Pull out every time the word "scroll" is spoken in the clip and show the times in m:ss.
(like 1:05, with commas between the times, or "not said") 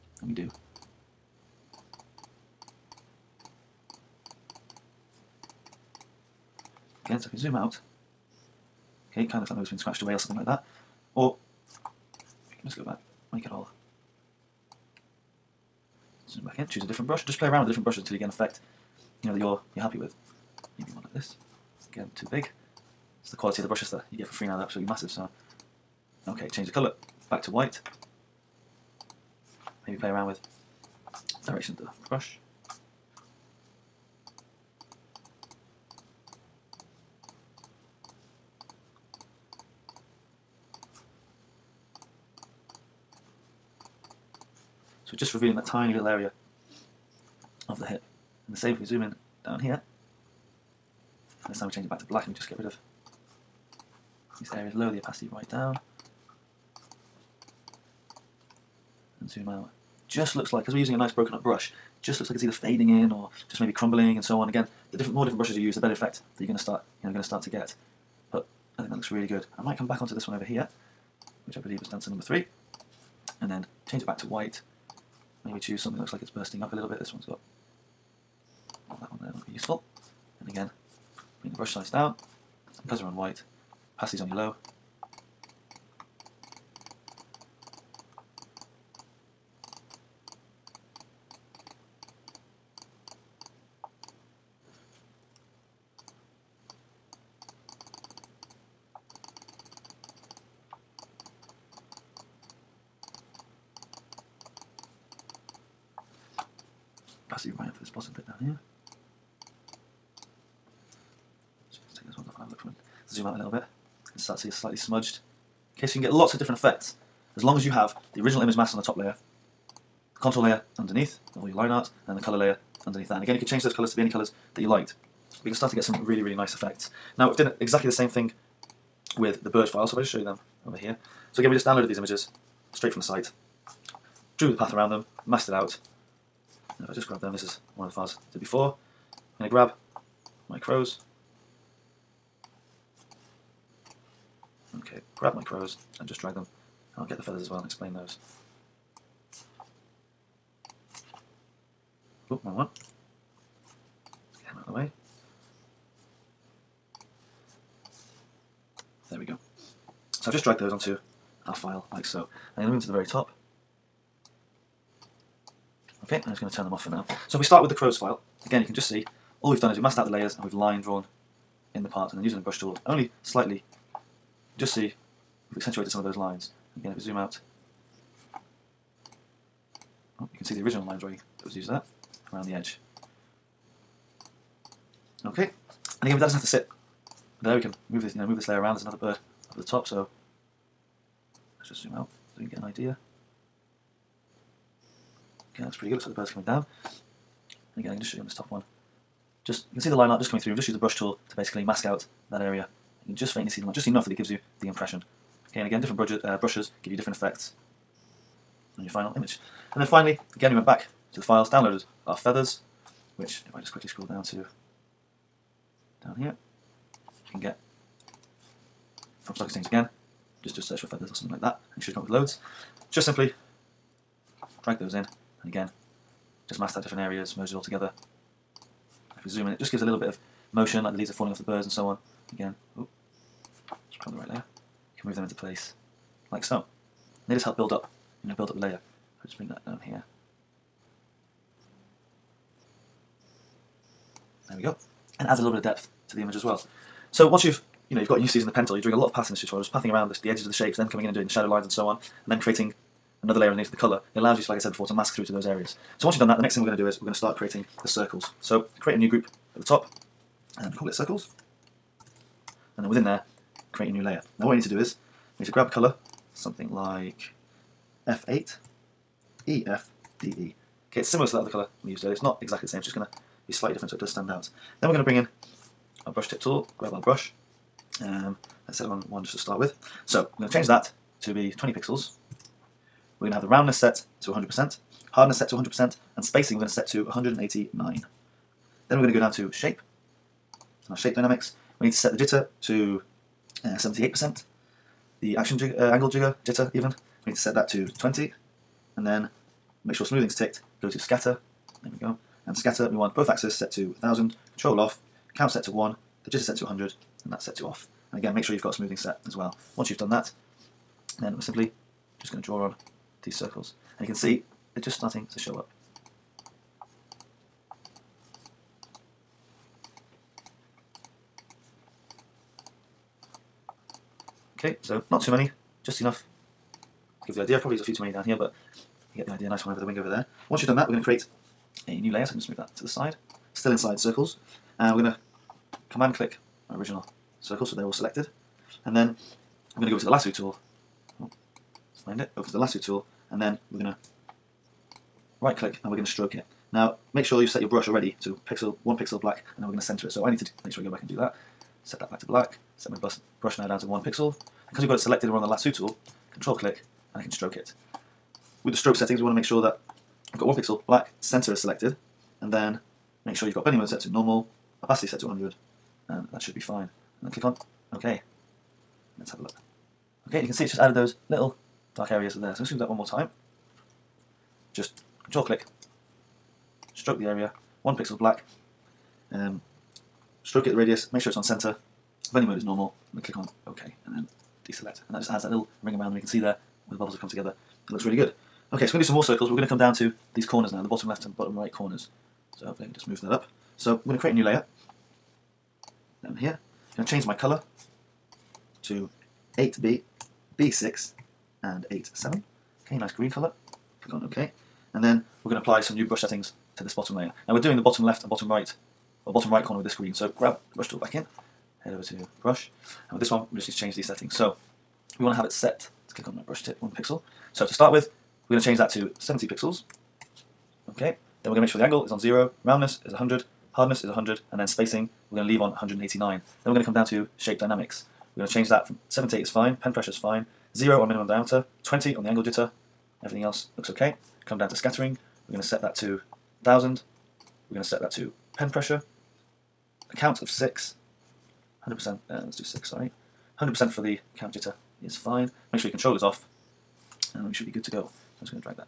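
3:33.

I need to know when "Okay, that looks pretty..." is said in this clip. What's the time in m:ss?
3:15.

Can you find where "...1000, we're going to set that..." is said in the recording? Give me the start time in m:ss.
7:16.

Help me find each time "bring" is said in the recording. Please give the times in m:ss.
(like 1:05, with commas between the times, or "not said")
1:21, 3:59, 4:35.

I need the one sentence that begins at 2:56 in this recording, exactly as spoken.
Again if we zoom out oh, you can see the original line drawing that was used there around the edge.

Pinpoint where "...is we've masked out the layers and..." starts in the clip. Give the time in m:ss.
2:49.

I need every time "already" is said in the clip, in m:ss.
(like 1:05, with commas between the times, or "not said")
5:47.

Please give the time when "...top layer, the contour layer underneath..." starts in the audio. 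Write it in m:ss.
1:58.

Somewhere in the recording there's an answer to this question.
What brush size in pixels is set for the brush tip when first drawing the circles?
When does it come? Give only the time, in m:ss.
4:41.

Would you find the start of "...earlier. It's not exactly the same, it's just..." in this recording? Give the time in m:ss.
4:32.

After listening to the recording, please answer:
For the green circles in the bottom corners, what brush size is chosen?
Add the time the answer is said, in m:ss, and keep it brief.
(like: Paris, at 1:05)
70 pixels, at 6:59.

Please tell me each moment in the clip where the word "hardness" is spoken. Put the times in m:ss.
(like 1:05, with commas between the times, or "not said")
4:45, 7:03.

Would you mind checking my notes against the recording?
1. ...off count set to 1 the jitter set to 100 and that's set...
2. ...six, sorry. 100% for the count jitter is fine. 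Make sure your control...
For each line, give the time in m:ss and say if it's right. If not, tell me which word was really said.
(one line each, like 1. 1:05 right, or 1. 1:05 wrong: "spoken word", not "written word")
1. 5:04 right
2. 7:22 right.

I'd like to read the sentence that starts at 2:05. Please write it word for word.
We you can start to get some really, really nice effects.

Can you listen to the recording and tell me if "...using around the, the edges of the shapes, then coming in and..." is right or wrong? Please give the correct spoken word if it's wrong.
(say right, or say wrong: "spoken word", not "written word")
wrong: "pathing", not "using".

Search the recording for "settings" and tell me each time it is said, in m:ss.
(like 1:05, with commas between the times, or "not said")
5:58, 6:46, 6:54.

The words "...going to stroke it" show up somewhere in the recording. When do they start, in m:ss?
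5:45.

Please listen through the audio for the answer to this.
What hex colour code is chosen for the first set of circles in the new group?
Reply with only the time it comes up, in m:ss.
4:28.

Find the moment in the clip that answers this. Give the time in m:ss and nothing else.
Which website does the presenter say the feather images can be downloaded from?
3:39.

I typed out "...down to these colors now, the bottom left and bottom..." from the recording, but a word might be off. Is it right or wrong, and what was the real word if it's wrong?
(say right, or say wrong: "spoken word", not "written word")
wrong: "corners", not "colors".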